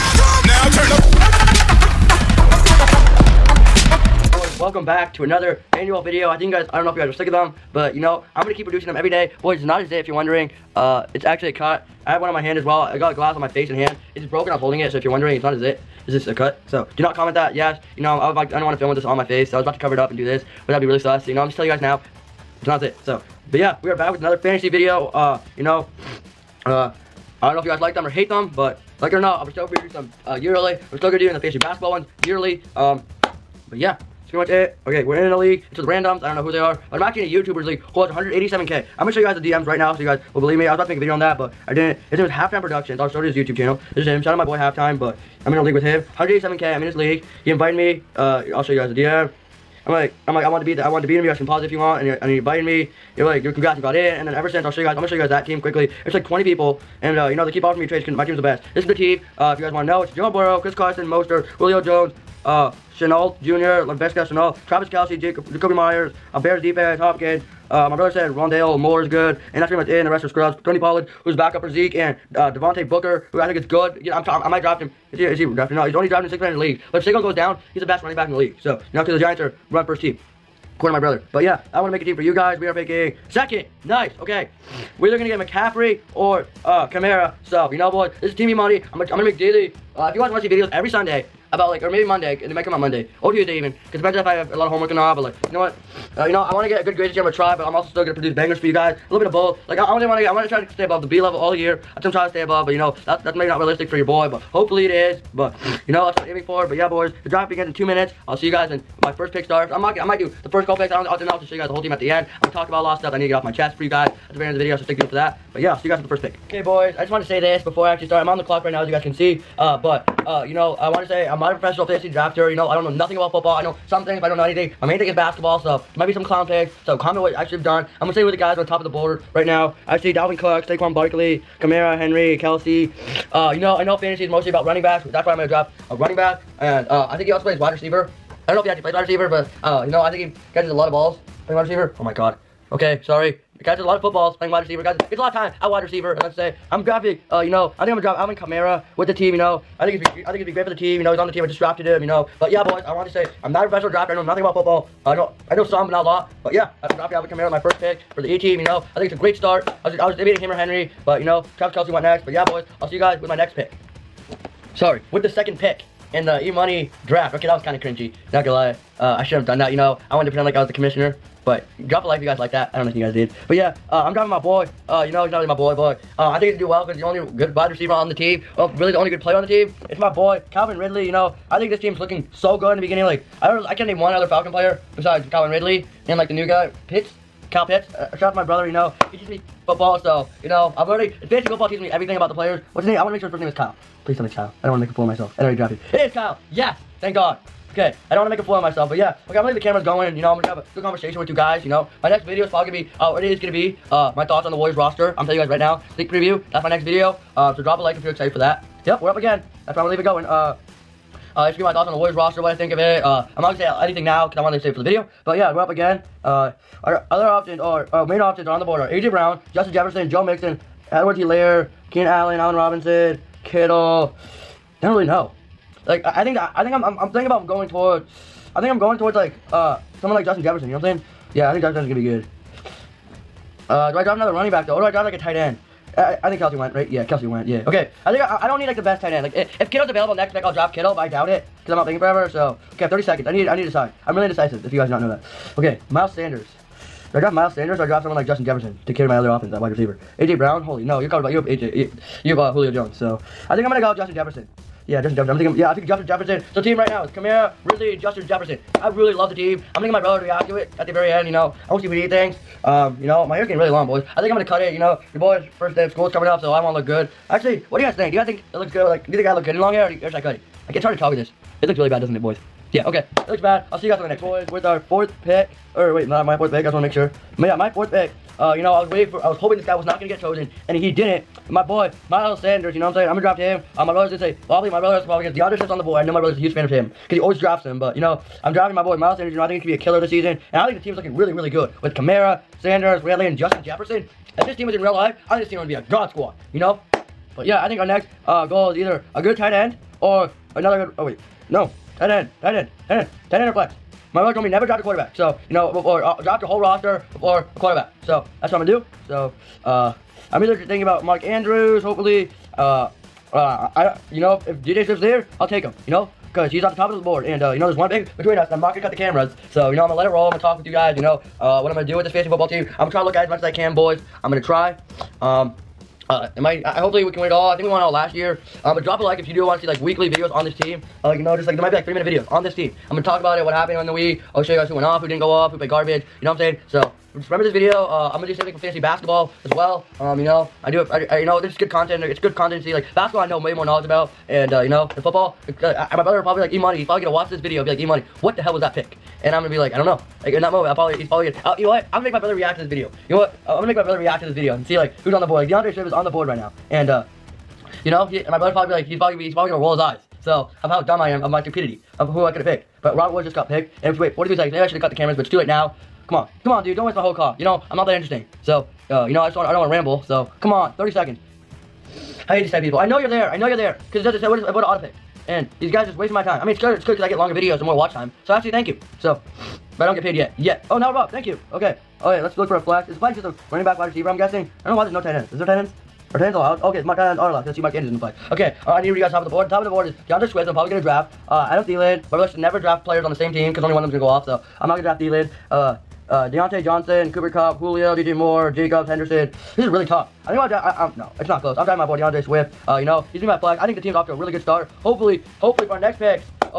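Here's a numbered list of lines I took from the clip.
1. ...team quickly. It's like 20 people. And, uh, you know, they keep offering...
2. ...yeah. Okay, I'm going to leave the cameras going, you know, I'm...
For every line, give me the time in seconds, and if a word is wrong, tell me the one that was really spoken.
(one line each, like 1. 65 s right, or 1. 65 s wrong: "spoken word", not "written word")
1. 55 s right
2. 198 s right.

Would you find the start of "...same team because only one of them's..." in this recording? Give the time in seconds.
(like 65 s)
393 s.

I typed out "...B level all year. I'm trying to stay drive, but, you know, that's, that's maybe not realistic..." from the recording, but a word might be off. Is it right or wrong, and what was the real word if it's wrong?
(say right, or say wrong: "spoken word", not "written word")
wrong: "above", not "drive".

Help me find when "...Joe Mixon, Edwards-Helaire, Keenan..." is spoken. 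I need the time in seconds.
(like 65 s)
220 s.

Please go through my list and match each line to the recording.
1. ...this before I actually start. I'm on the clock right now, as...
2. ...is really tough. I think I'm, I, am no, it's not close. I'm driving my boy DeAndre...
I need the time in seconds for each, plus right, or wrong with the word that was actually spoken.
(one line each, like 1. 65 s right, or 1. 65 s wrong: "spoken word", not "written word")
1. 117 s right
2. 399 s right.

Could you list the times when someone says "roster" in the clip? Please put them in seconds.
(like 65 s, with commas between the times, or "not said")
204 s, 212 s, 306 s.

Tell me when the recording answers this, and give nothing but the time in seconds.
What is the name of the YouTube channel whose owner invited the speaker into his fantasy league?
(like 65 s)
42 s.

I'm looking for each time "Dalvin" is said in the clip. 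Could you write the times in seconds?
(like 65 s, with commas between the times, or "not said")
130 s.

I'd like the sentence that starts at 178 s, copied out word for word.
Oh, really the only good player on the team.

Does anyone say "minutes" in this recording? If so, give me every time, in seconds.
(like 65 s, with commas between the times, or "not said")
107 s, 331 s.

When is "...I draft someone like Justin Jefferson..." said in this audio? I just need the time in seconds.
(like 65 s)
247 s.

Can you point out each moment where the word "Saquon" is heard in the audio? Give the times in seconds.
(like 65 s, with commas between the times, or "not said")
77 s, 130 s.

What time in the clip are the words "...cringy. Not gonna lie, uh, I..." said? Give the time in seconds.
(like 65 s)
167 s.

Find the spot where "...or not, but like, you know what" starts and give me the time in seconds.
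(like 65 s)
94 s.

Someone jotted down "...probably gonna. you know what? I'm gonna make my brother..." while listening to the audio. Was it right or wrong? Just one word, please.
right.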